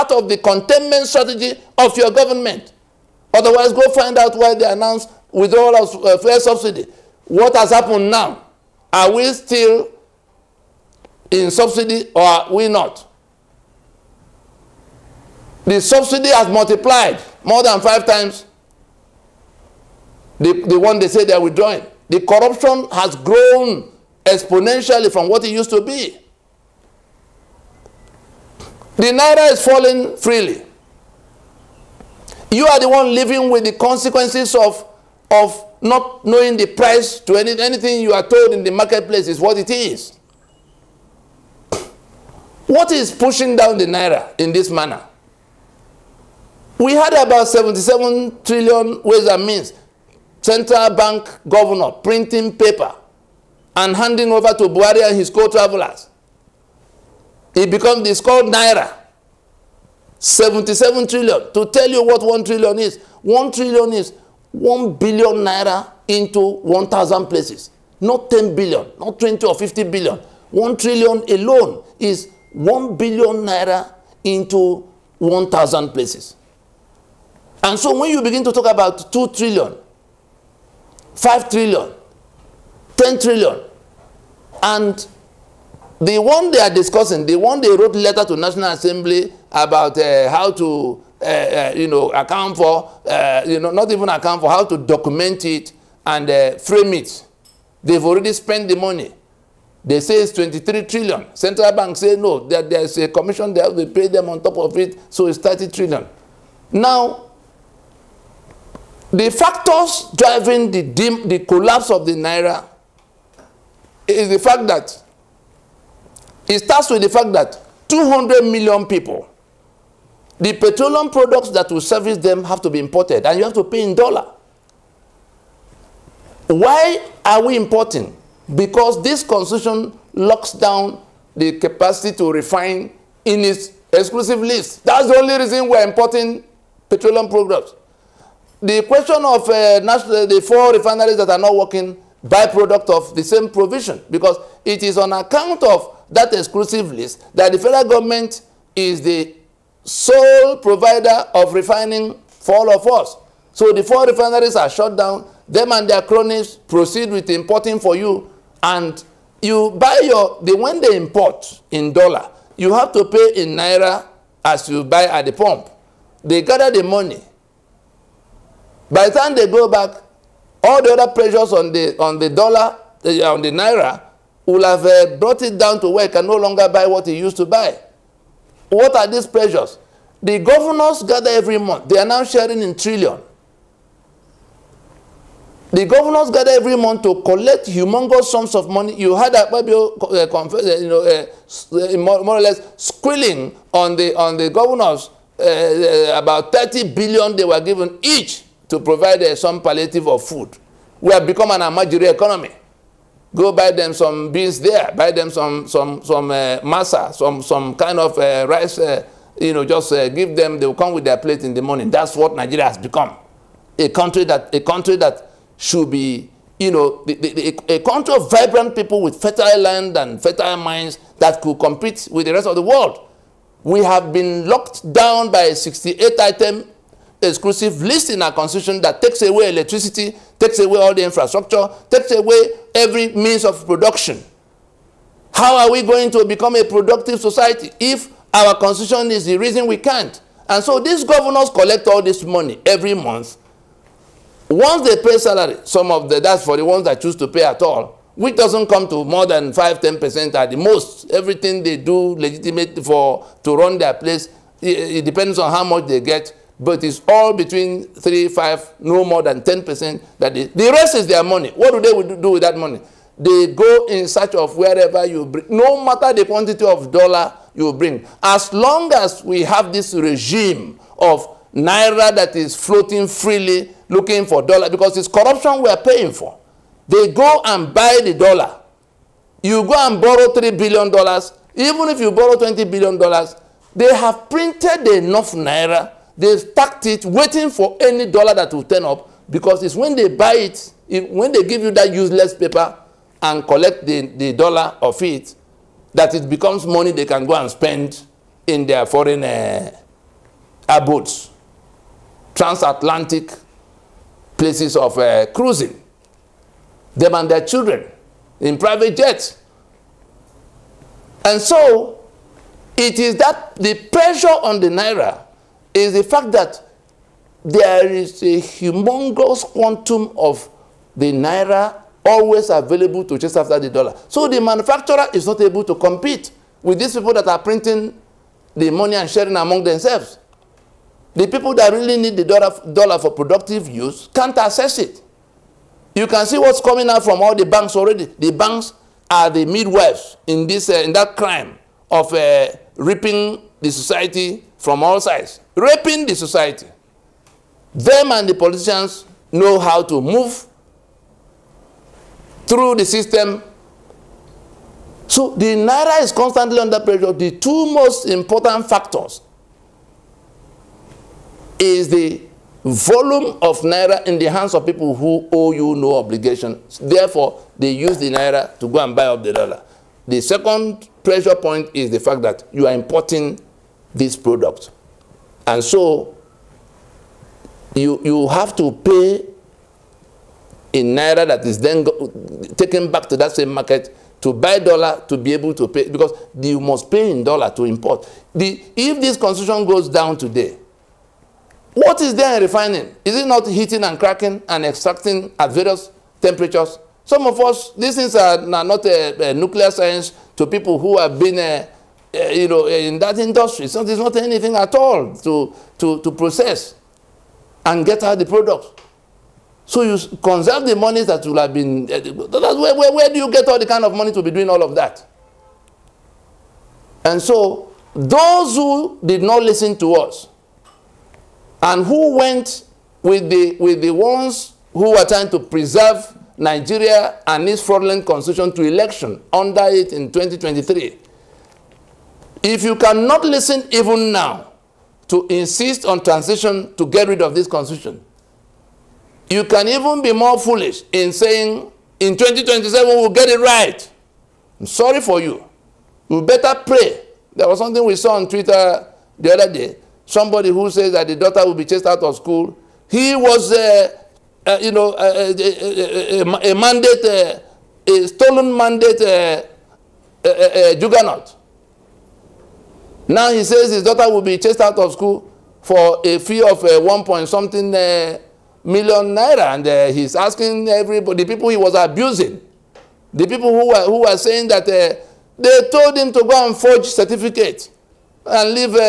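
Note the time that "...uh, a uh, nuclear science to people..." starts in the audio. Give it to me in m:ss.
6:39.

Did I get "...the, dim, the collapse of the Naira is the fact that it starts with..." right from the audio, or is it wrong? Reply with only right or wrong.
right.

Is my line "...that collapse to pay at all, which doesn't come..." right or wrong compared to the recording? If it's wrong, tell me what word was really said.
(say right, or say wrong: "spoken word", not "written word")
wrong: "choose", not "collapse".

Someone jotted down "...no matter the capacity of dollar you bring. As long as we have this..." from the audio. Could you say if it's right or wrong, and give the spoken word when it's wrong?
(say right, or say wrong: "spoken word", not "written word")
wrong: "quantity", not "capacity".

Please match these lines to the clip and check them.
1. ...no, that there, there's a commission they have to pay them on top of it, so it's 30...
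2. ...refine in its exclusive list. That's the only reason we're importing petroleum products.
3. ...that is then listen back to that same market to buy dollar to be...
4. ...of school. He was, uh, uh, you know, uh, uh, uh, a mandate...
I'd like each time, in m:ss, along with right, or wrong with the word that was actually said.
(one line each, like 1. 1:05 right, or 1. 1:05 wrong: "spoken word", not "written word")
1. 1:42 right
2. 2:12 right
3. 6:21 wrong: "taken", not "listen"
4. 7:32 right.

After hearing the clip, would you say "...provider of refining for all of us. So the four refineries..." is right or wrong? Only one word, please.
right.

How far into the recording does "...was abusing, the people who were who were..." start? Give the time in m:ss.
7:51.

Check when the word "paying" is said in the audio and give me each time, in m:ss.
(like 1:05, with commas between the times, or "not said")
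4:35.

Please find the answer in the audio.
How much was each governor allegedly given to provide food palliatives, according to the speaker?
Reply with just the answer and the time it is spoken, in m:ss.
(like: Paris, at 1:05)
30 billion, at 3:16.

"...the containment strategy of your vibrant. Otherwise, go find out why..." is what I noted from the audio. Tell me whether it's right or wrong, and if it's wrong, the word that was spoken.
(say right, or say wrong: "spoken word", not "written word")
wrong: "government", not "vibrant".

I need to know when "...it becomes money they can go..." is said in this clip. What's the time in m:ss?
4:56.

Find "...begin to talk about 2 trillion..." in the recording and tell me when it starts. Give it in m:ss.
1:18.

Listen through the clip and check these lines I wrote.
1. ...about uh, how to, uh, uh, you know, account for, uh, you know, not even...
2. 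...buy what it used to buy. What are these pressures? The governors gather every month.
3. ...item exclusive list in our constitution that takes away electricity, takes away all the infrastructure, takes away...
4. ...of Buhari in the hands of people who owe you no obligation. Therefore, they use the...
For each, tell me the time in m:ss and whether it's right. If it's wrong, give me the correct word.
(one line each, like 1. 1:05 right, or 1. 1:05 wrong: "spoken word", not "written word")
1. 1:29 right
2. 2:56 right
3. 3:46 right
4. 6:03 wrong: "Naira", not "Buhari".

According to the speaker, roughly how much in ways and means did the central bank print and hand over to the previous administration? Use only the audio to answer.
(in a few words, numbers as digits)
77 trillion.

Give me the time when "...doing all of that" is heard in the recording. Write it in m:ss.
6:54.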